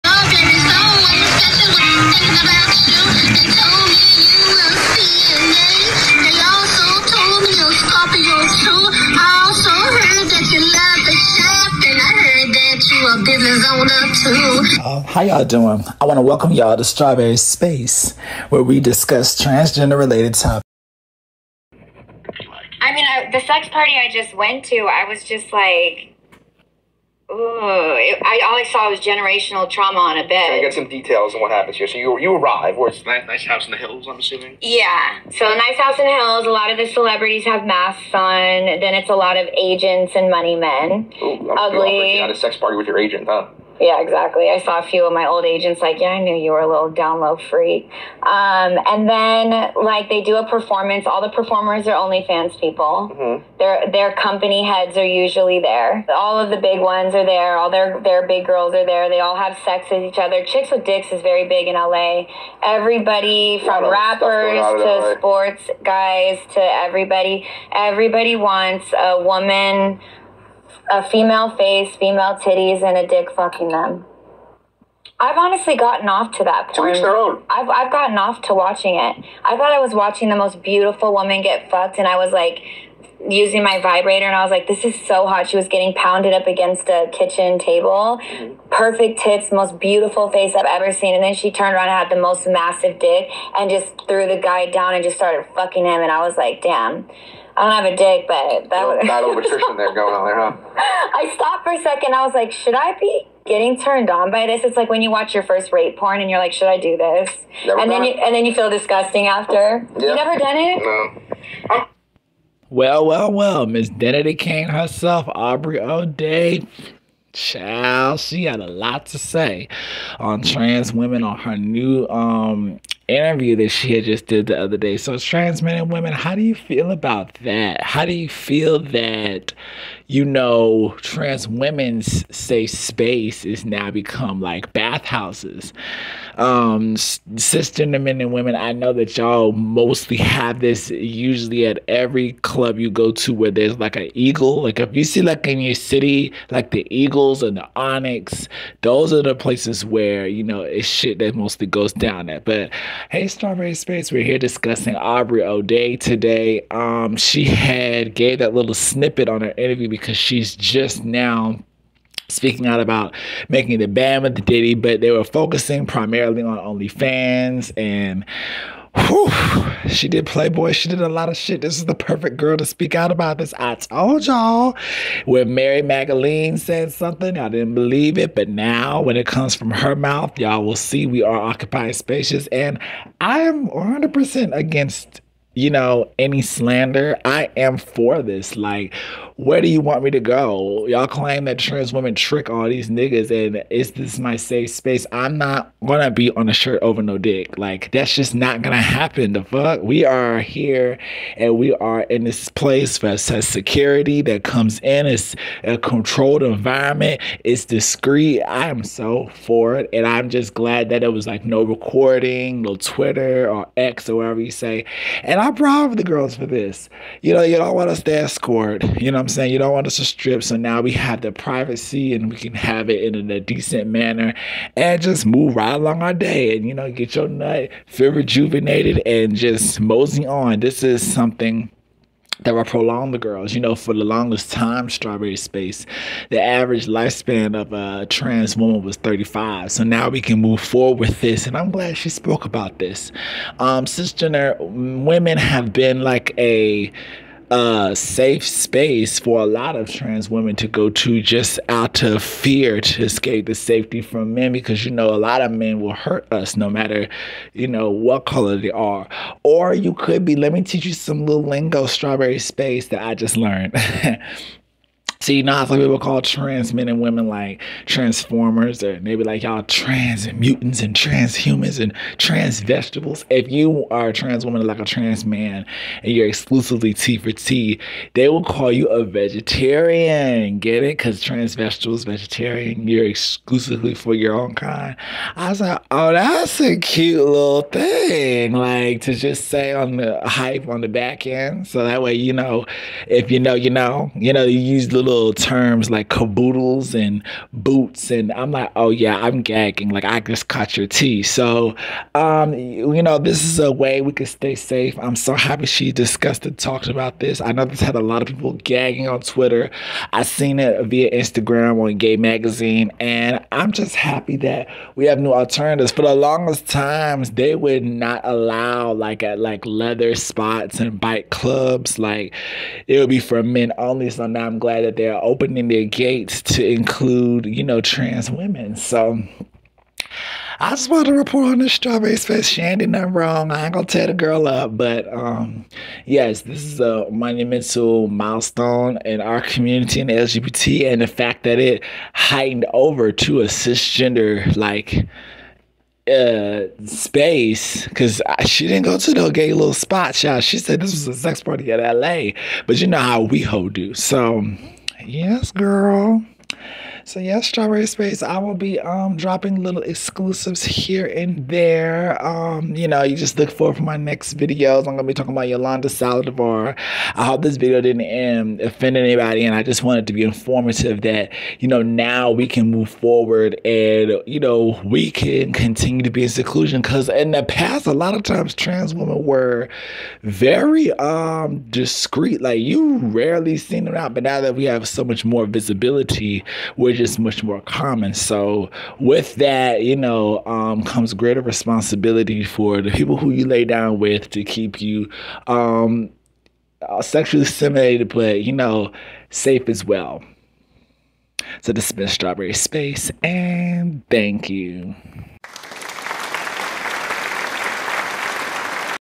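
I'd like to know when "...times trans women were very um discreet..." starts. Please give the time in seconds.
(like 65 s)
378 s.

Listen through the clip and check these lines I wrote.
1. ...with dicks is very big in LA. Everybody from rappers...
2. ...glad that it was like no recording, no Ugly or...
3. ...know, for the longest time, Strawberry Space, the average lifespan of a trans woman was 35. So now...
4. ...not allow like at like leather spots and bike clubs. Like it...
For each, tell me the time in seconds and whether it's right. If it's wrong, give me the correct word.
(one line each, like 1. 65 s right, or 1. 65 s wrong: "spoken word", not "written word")
1. 60 s right
2. 210 s wrong: "Twitter", not "Ugly"
3. 233 s right
4. 317 s right.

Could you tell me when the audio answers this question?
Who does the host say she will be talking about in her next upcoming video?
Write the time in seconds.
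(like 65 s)
365 s.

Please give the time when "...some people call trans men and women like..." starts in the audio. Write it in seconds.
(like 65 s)
265 s.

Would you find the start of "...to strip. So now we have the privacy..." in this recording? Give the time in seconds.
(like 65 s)
219 s.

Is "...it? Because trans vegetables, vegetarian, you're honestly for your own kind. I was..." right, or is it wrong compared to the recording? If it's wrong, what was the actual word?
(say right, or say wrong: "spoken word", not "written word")
wrong: "exclusively", not "honestly".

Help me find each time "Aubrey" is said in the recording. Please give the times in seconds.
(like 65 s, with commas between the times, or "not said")
115 s, 154 s.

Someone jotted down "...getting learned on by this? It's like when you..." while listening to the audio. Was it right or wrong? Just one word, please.
wrong.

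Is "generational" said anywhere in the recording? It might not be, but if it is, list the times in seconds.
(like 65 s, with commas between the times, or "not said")
28 s.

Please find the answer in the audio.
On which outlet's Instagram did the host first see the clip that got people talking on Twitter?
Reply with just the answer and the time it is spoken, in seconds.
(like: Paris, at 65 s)
Gay Magazine, at 311 s.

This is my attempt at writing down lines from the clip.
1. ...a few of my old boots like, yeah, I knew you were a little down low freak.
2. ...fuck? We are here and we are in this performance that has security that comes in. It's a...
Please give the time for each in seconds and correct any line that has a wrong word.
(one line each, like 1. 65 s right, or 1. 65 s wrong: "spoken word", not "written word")
1. 44 s wrong: "agents", not "boots"
2. 199 s wrong: "place", not "performance".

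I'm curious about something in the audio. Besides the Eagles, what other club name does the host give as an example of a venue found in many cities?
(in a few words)
Onyx.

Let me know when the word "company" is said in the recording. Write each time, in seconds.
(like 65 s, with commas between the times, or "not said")
54 s.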